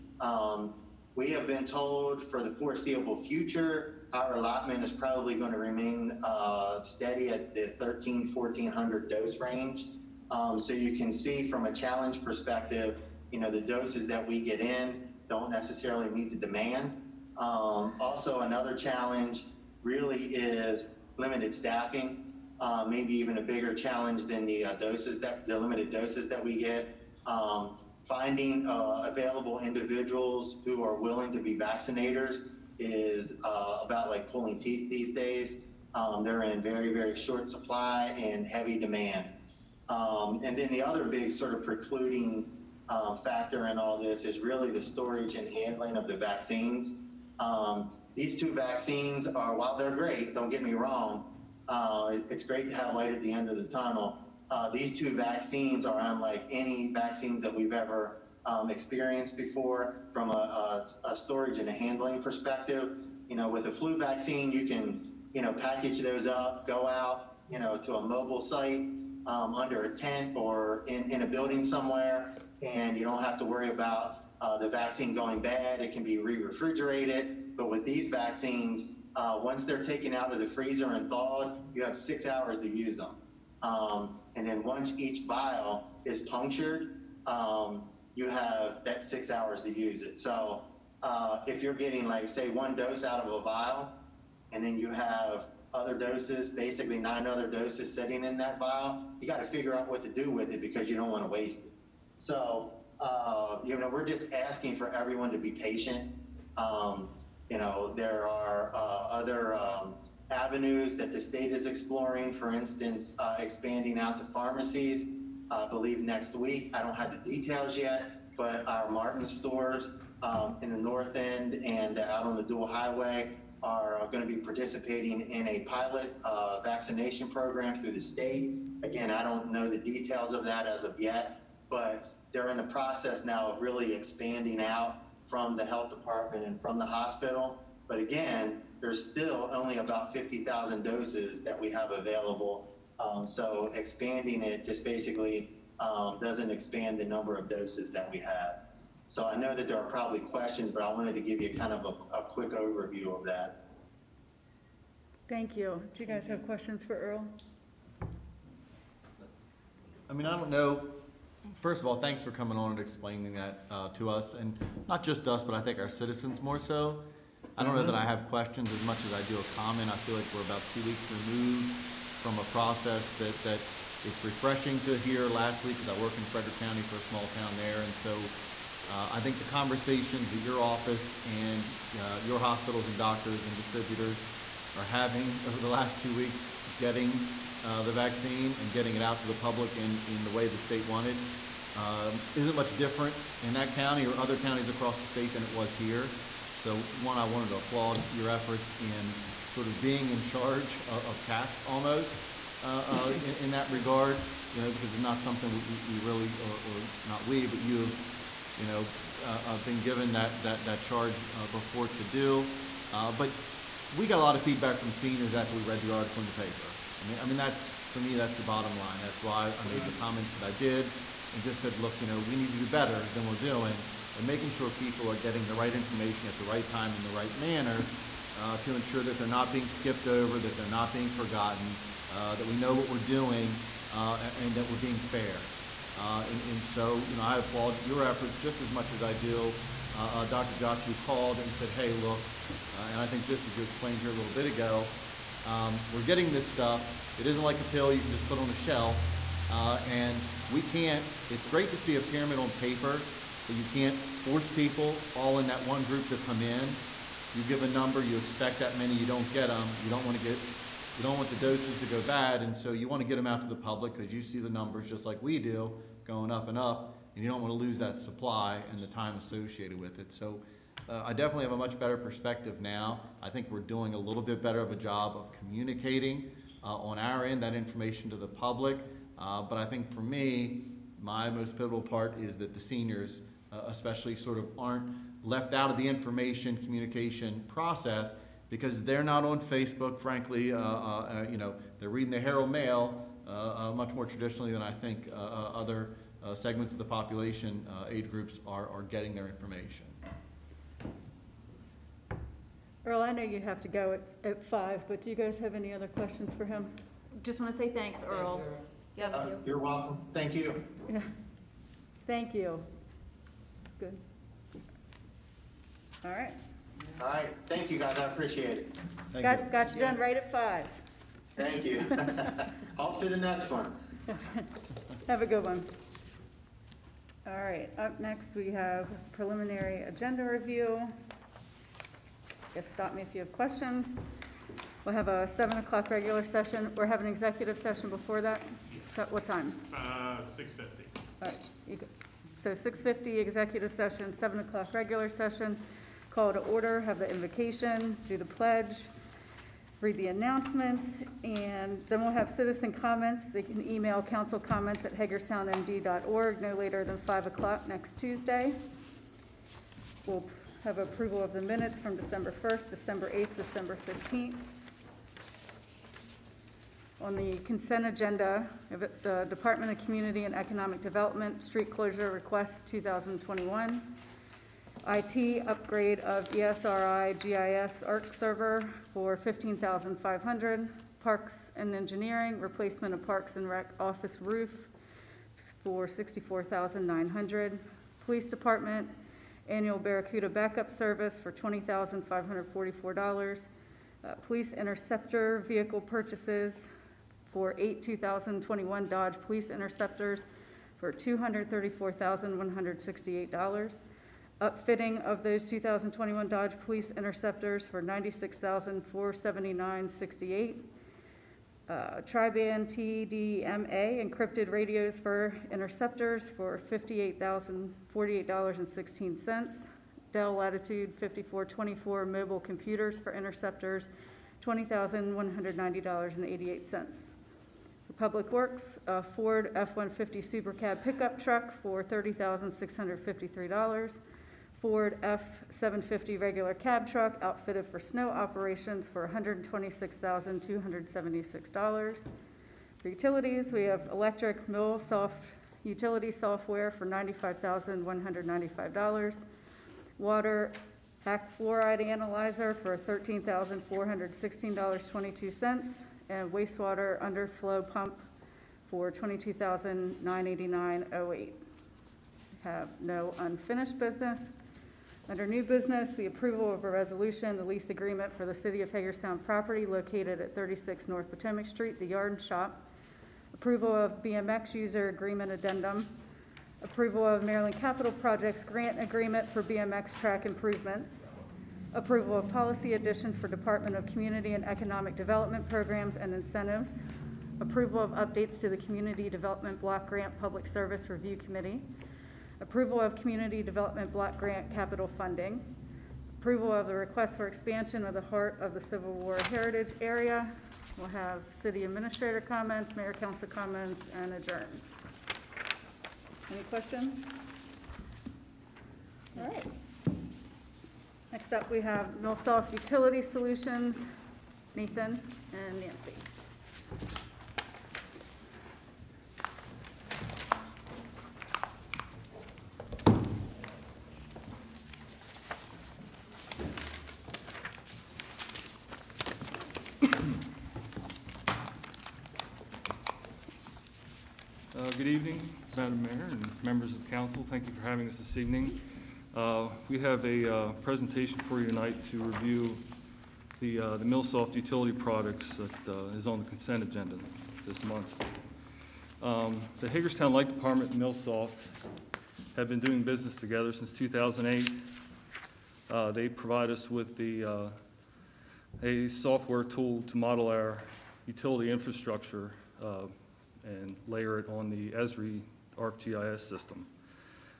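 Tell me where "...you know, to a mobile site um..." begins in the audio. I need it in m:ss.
1:07.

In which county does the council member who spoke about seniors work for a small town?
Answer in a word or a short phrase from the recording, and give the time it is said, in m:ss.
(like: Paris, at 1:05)
Frederick County, at 2:56.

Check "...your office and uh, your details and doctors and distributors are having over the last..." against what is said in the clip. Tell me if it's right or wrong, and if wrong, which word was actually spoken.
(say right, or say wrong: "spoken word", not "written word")
wrong: "hospitals", not "details".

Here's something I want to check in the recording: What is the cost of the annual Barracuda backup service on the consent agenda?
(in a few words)
$20,544.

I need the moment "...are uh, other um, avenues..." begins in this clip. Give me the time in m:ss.
1:48.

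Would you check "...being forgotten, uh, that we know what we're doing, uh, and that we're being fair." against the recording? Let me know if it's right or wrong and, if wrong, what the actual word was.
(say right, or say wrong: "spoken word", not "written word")
right.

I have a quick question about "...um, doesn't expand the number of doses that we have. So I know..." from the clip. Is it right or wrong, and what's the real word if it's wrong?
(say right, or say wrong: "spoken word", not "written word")
right.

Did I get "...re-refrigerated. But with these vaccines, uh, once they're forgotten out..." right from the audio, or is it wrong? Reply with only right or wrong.
wrong.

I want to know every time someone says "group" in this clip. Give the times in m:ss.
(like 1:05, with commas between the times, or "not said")
4:15, 4:58.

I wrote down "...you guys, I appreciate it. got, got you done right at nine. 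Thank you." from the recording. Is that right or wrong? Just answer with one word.
wrong.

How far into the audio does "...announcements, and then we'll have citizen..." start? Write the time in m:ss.
5:50.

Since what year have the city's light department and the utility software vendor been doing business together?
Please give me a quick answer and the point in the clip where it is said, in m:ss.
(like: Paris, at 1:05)
2008, at 9:13.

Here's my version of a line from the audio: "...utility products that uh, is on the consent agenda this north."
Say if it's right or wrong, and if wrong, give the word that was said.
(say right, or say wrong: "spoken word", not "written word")
wrong: "month", not "north".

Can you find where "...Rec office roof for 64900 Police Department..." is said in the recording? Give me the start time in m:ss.
6:23.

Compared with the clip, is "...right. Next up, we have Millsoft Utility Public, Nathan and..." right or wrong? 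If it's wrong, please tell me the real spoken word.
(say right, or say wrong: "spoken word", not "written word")
wrong: "Solutions", not "Public".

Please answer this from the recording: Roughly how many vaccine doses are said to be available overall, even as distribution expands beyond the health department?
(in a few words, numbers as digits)
50,000.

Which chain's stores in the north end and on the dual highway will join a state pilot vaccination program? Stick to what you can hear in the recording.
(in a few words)
Martin.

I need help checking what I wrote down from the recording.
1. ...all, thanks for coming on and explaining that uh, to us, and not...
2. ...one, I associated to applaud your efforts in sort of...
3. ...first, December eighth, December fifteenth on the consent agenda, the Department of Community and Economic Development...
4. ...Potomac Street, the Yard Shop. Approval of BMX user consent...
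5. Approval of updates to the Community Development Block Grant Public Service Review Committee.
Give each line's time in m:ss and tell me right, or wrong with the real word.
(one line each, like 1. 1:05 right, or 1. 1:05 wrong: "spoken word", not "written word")
1. 2:41 right
2. 3:16 wrong: "wanted", not "associated"
3. 6:02 right
4. 7:51 wrong: "agreement", not "consent"
5. 8:07 right.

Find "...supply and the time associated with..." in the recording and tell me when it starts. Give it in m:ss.
4:27.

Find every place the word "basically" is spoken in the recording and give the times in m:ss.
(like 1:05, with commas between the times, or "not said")
1:36, 2:24.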